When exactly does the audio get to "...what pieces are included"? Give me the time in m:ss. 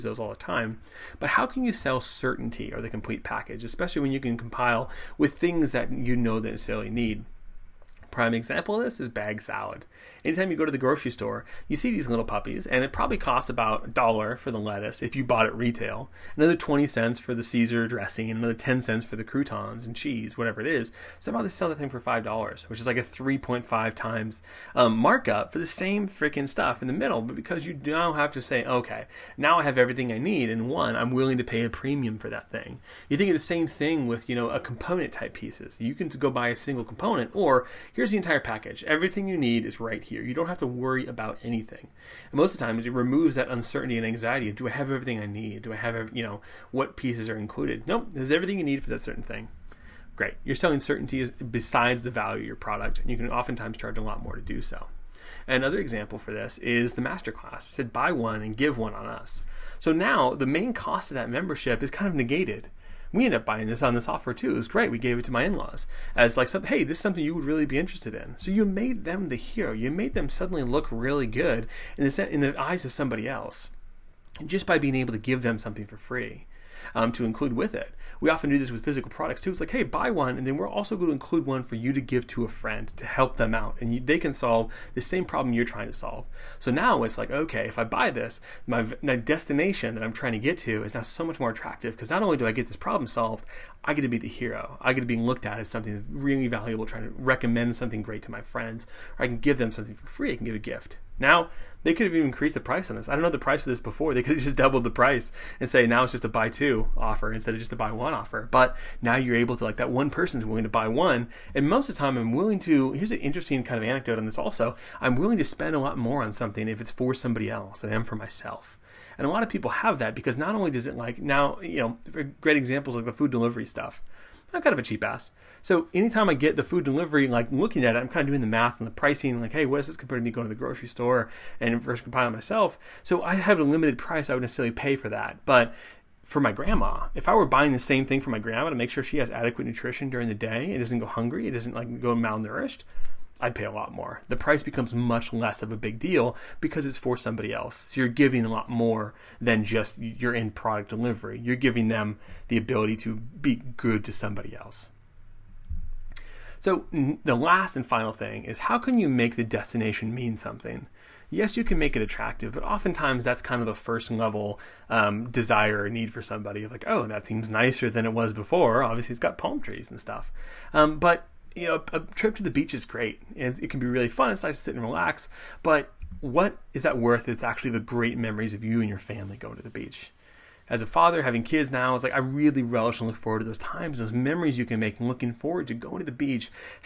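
0:46.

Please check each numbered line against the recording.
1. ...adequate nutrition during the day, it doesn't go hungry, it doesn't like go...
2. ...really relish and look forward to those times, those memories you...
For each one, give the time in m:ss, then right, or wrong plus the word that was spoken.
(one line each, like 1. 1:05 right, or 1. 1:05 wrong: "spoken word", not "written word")
1. 2:19 right
2. 3:02 right.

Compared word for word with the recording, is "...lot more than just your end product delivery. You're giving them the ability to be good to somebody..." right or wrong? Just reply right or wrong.
right.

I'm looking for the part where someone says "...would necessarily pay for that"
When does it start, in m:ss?
2:14.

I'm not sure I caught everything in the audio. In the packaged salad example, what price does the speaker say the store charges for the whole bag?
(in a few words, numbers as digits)
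$5.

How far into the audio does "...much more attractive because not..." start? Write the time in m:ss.
1:31.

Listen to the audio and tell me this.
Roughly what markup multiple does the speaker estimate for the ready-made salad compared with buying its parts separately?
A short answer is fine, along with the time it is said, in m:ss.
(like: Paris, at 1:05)
3.5 times, at 0:23.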